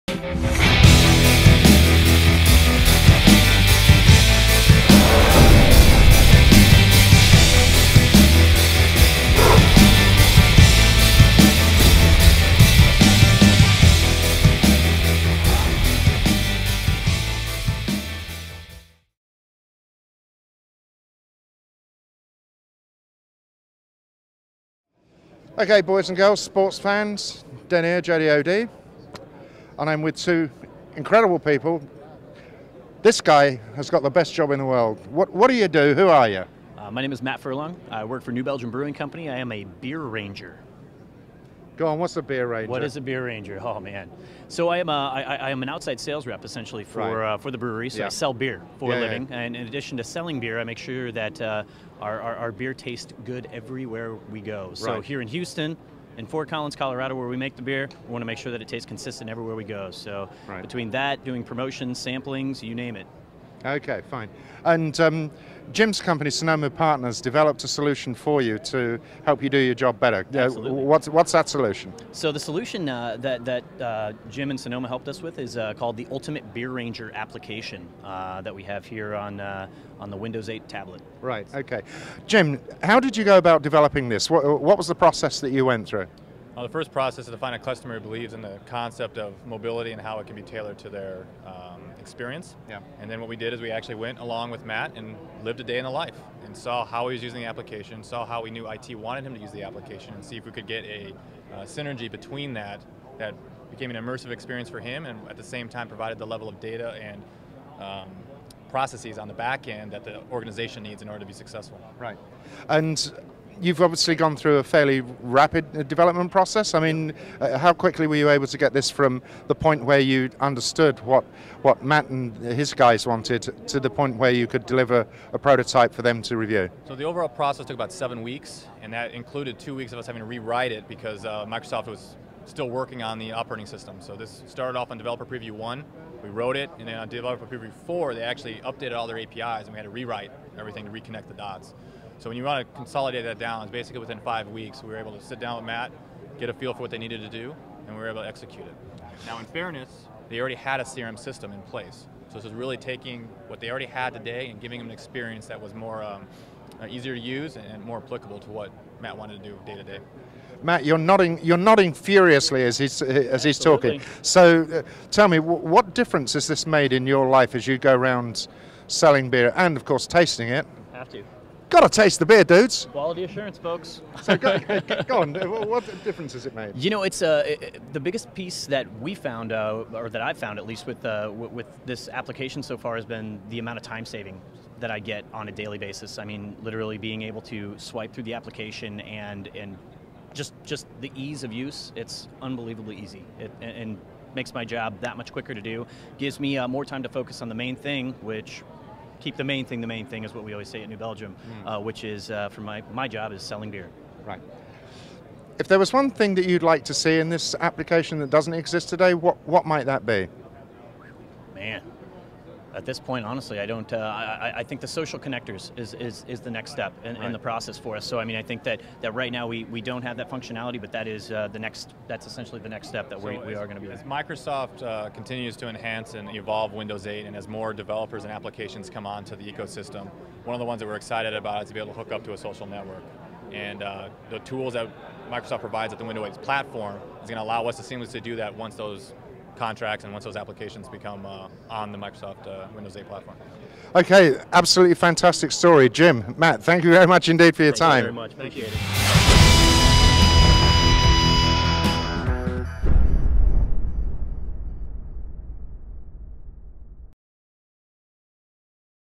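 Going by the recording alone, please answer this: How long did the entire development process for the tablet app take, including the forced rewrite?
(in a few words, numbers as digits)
7 weeks.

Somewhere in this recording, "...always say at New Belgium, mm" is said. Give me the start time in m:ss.
3:20.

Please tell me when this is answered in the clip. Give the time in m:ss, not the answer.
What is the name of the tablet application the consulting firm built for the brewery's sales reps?
1:16.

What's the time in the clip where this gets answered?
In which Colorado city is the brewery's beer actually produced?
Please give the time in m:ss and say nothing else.
0:56.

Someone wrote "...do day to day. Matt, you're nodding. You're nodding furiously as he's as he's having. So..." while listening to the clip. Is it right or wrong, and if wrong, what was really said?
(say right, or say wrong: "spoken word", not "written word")
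wrong: "talking", not "having".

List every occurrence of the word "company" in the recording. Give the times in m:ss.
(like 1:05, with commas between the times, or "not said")
0:38, 1:06.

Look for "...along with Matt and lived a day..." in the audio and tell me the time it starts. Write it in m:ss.
1:34.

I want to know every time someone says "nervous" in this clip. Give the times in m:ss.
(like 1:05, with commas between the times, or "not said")
not said.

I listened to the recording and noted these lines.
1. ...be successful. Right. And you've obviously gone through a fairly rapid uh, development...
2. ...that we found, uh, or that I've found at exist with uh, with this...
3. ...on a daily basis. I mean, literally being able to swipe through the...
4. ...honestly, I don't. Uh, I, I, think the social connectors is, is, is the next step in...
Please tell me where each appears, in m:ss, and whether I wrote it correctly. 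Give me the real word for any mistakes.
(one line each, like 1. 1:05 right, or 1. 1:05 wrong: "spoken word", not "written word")
1. 1:51 right
2. 2:58 wrong: "least", not "exist"
3. 3:05 right
4. 3:33 right.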